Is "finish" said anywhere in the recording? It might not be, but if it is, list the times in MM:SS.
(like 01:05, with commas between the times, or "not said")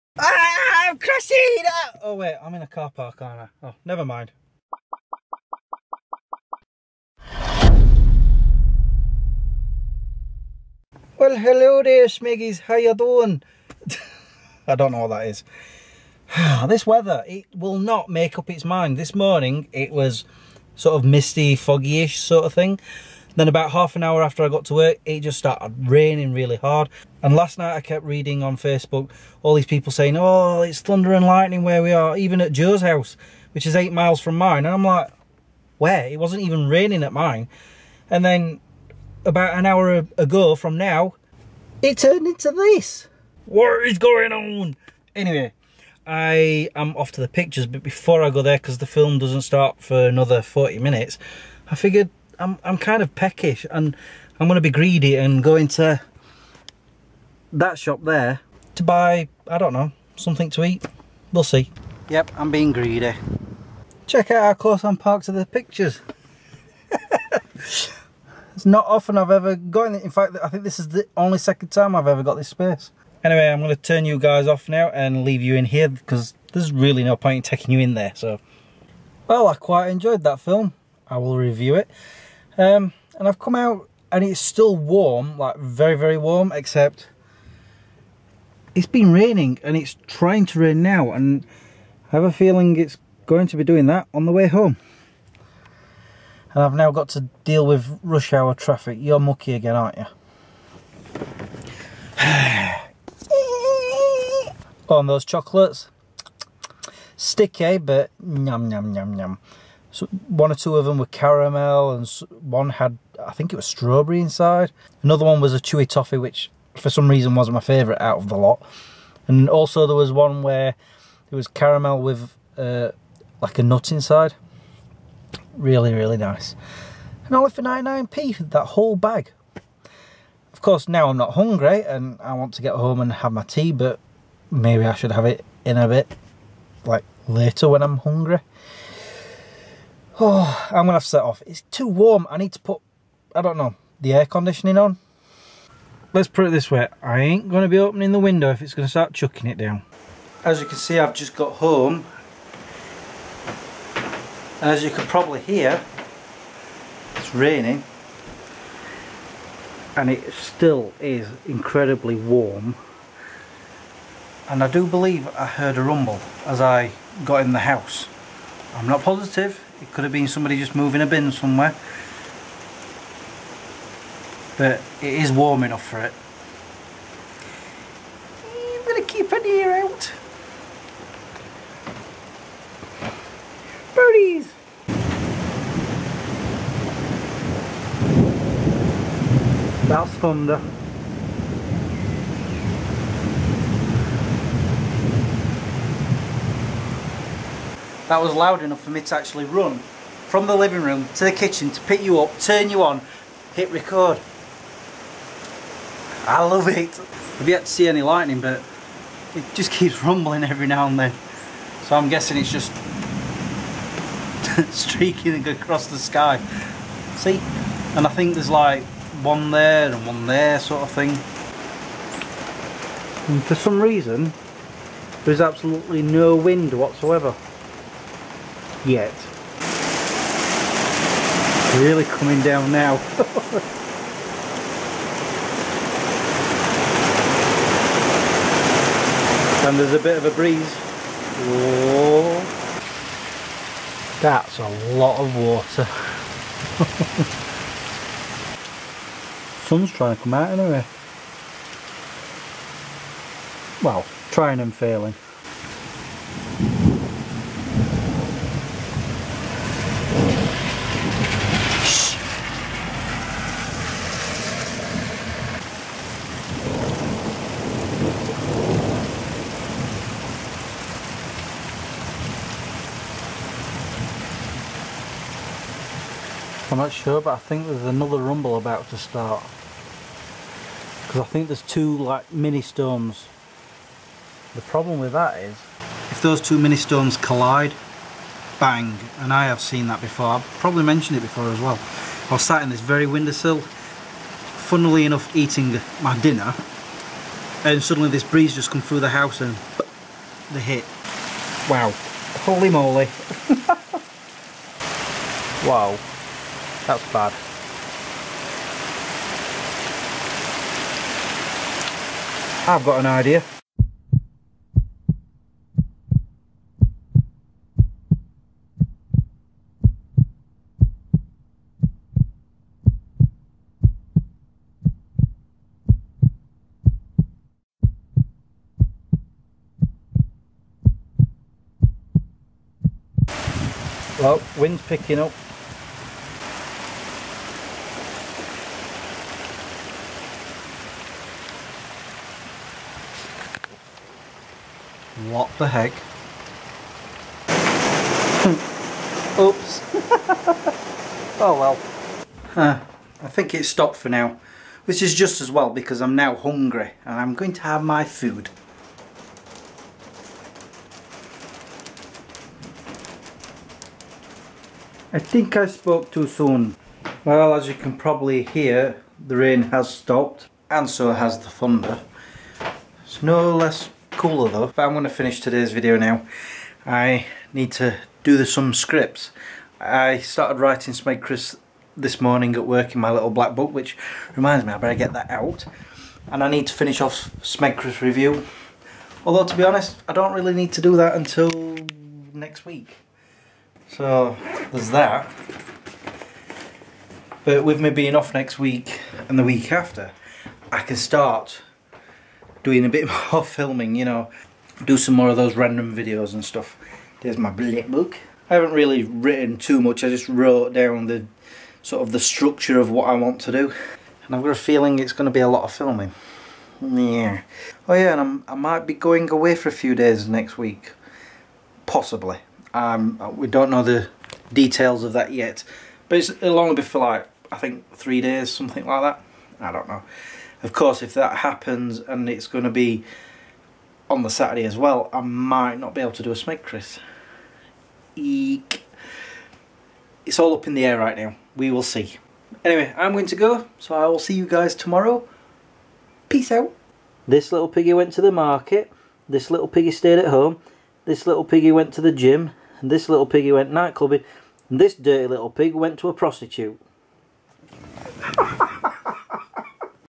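06:15, 06:26.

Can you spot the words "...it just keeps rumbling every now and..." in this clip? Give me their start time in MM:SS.
03:29.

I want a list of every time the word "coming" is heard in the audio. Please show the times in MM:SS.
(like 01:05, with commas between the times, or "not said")
03:52.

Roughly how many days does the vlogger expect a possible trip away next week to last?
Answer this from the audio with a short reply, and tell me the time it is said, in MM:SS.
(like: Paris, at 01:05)
3, at 07:07.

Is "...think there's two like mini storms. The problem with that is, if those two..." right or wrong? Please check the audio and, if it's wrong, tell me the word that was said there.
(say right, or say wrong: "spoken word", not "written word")
right.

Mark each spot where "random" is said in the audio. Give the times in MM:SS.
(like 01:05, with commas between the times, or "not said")
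06:45.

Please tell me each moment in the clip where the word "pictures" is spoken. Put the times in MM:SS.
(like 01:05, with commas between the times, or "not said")
00:47, 01:05.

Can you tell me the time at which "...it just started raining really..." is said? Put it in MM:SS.
00:25.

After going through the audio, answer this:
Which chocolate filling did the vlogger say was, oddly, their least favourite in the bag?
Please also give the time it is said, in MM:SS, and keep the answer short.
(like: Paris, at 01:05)
chewy toffee, at 01:55.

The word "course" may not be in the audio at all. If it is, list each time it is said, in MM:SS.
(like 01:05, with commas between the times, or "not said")
02:10, 07:10.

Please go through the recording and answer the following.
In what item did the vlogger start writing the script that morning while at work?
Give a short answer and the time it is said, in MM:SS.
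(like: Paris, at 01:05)
little black book, at 06:23.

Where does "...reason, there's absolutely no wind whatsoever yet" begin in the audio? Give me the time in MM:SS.
03:43.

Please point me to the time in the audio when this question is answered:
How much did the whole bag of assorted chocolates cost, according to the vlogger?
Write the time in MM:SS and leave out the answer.
02:07.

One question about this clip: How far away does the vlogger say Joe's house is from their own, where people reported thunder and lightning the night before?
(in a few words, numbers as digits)
8 miles.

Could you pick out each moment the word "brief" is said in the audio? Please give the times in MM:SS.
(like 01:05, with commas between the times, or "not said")
not said.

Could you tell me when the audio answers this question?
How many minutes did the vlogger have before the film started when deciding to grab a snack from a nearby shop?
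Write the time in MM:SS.
00:50.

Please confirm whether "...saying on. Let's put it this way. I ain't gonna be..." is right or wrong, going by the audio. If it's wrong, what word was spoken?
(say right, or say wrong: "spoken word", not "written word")
wrong: "conditioning", not "saying".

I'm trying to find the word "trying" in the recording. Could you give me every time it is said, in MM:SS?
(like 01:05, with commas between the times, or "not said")
01:30, 04:09, 04:14.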